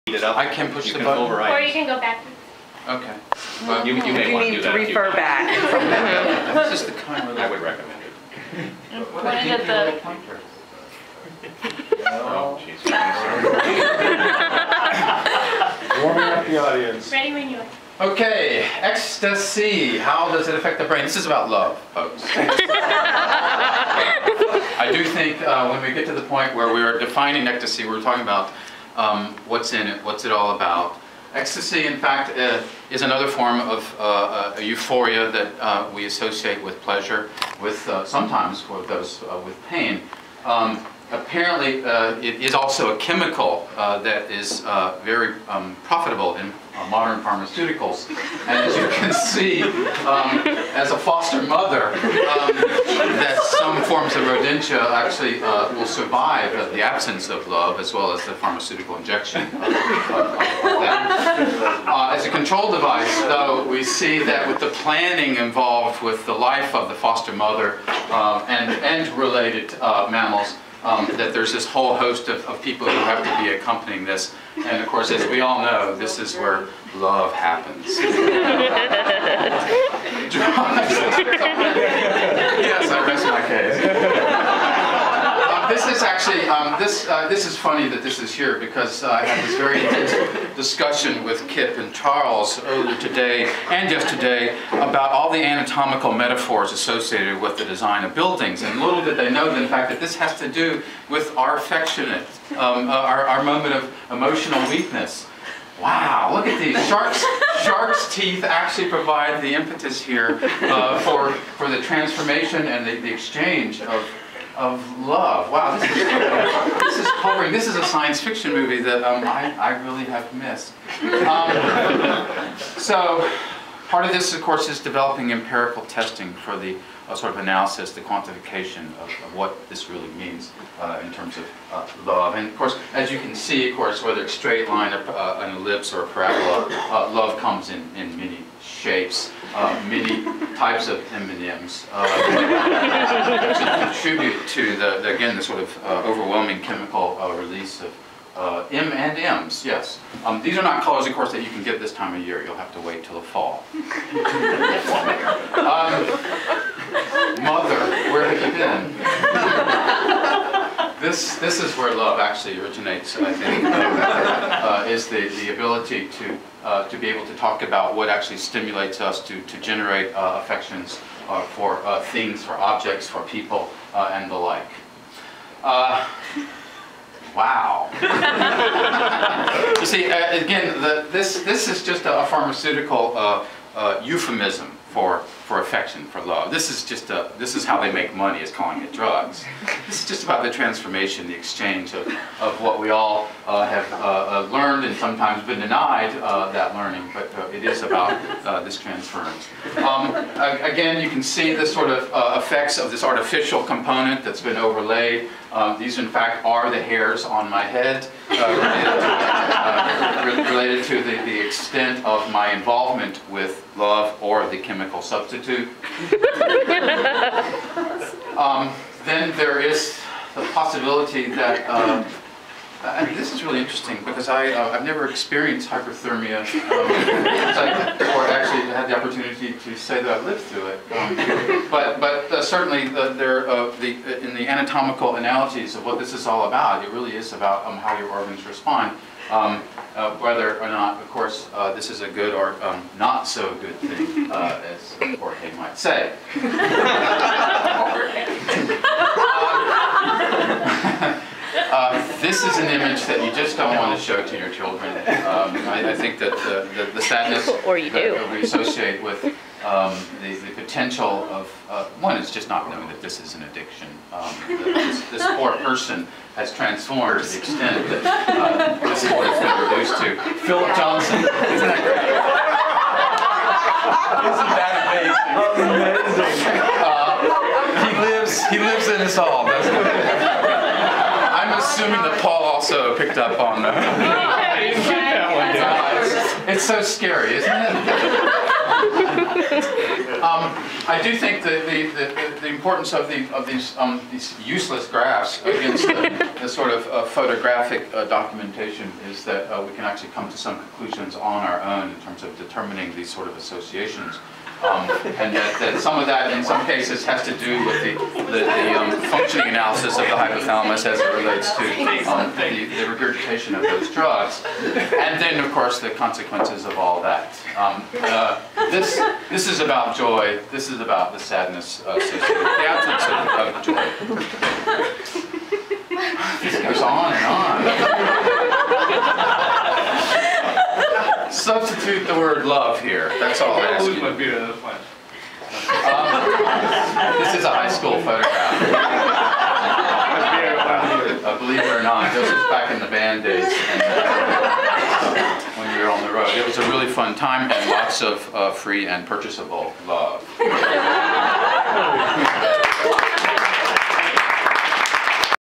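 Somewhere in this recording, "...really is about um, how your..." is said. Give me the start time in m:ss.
3:56.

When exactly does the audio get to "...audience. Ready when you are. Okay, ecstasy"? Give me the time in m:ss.
0:16.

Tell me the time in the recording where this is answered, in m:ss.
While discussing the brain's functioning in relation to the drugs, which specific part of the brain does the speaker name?
5:10.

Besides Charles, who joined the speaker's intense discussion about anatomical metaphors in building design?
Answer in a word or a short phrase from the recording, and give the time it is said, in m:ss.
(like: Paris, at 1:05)
Kip, at 1:31.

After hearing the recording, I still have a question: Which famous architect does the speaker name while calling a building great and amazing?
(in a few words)
Philip Johnson.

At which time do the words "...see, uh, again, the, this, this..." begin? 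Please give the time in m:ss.
2:59.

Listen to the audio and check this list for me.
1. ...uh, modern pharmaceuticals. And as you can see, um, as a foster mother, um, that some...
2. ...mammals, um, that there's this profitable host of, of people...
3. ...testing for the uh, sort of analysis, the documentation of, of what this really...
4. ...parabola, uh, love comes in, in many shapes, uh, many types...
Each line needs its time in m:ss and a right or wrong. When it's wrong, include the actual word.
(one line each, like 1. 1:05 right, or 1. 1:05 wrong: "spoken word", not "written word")
1. 0:46 right
2. 1:10 wrong: "whole", not "profitable"
3. 2:05 wrong: "quantification", not "documentation"
4. 2:16 right.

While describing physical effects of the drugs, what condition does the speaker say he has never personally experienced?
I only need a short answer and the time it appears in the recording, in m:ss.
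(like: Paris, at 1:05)
Hyperthermia, at 3:45.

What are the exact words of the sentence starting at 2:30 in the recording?
Um, these are not colors, of course, that you can get this time of year.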